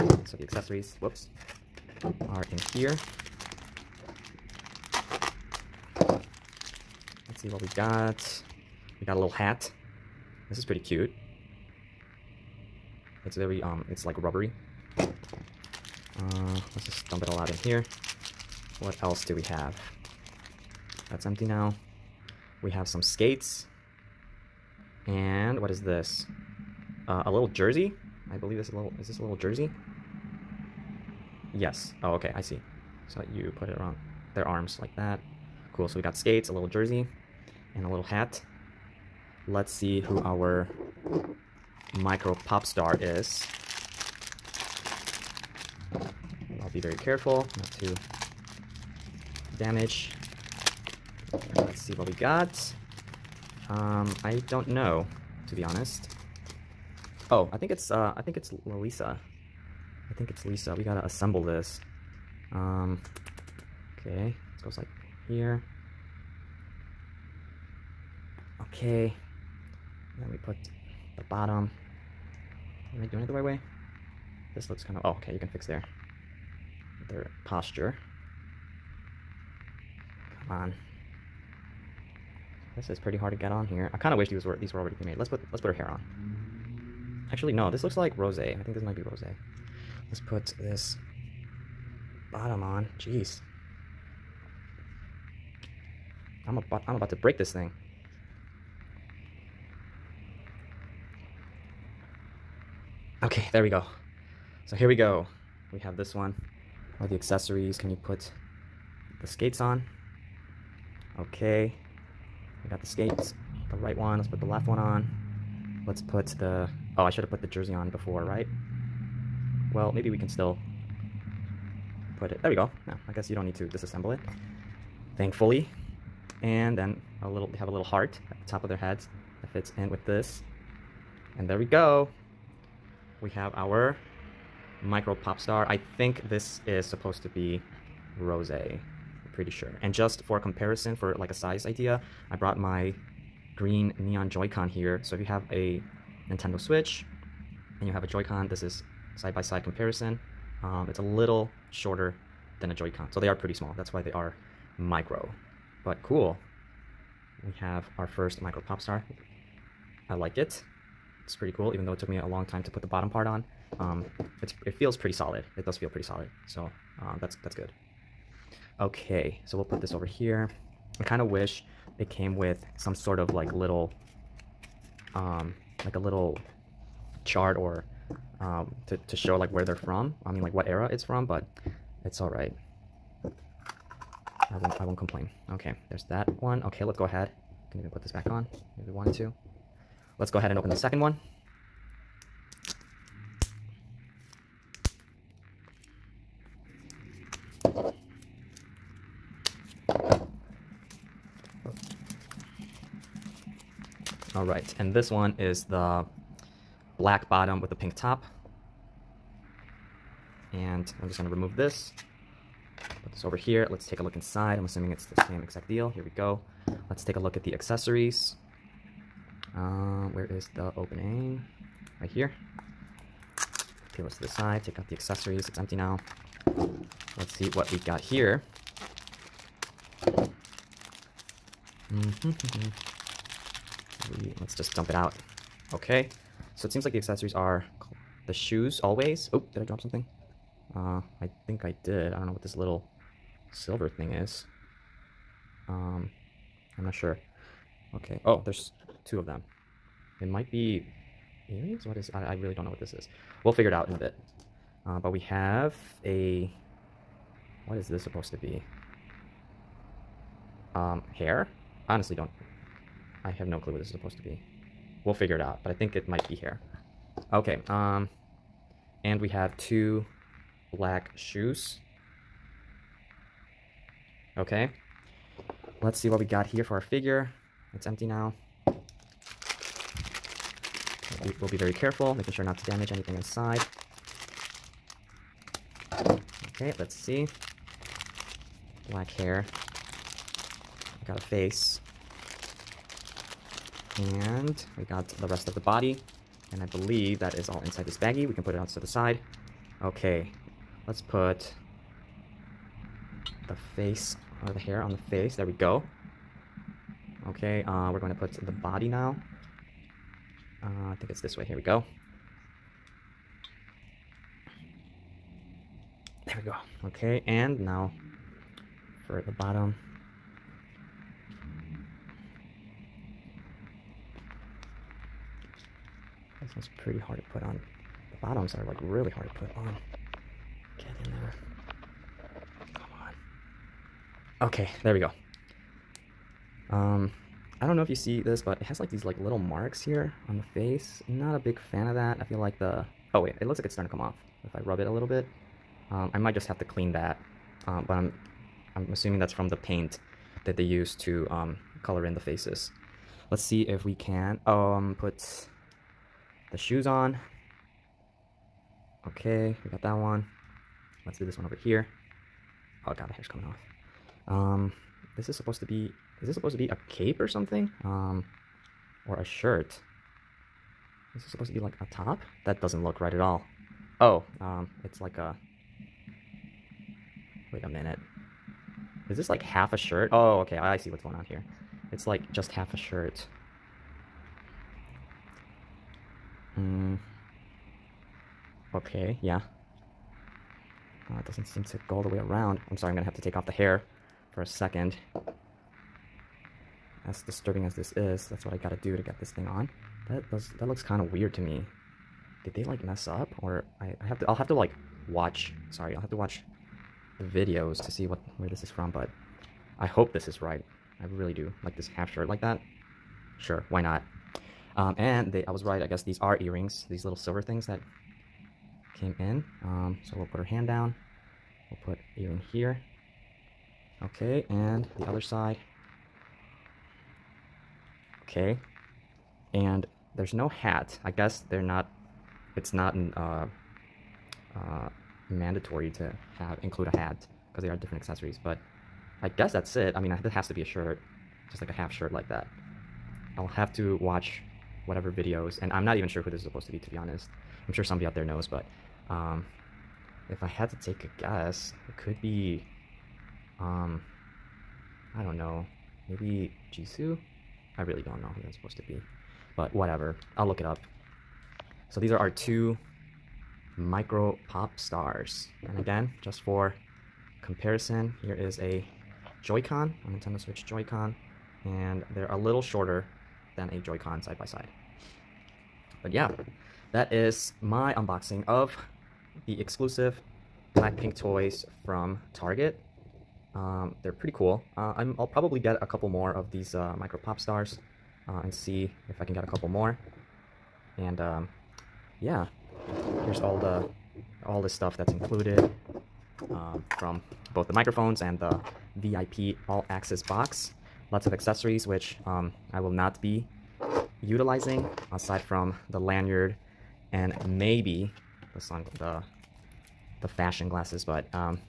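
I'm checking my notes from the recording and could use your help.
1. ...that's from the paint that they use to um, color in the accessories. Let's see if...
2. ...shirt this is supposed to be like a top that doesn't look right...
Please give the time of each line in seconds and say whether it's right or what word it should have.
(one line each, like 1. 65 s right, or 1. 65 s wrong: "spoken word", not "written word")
1. 349 s wrong: "faces", not "accessories"
2. 369 s right.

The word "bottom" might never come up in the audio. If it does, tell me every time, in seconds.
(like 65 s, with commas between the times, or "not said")
71 s, 92 s, 162 s, 207 s, 319 s, 328 s.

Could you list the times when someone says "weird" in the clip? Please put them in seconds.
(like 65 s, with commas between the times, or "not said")
401 s.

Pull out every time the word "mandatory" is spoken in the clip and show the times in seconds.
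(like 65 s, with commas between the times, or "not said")
435 s.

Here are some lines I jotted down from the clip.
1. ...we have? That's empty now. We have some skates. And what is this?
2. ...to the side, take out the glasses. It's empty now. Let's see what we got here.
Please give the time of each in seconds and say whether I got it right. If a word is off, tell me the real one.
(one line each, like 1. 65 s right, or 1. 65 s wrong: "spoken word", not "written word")
1. 19 s right
2. 224 s wrong: "accessories", not "glasses".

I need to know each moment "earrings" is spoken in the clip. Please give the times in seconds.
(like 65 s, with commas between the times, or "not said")
251 s, 416 s, 422 s.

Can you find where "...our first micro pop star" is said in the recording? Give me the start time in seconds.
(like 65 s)
157 s.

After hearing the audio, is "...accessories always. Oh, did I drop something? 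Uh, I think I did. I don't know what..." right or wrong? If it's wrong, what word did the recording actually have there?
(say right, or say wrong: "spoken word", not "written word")
wrong: "shoes", not "accessories".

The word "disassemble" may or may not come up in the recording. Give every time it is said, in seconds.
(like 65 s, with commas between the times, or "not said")
123 s.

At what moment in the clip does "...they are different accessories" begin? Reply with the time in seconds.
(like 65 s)
437 s.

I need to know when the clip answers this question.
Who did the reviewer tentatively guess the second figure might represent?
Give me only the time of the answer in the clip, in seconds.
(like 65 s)
456 s.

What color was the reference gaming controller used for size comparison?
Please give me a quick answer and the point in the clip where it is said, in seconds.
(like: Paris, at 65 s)
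green neon, at 143 s.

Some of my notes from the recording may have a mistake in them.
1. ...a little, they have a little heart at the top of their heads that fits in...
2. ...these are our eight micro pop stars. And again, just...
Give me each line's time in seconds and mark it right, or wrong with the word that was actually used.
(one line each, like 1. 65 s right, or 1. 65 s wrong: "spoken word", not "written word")
1. 127 s right
2. 461 s wrong: "two", not "eight".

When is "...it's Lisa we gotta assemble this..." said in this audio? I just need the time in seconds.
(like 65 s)
60 s.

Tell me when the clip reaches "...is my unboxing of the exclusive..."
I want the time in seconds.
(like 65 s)
477 s.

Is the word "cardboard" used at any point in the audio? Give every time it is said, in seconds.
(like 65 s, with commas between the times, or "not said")
not said.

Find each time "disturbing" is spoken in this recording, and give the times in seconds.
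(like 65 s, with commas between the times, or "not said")
397 s.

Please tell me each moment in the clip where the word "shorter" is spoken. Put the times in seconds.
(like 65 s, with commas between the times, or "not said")
151 s, 472 s.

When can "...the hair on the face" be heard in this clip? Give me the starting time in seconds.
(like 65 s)
304 s.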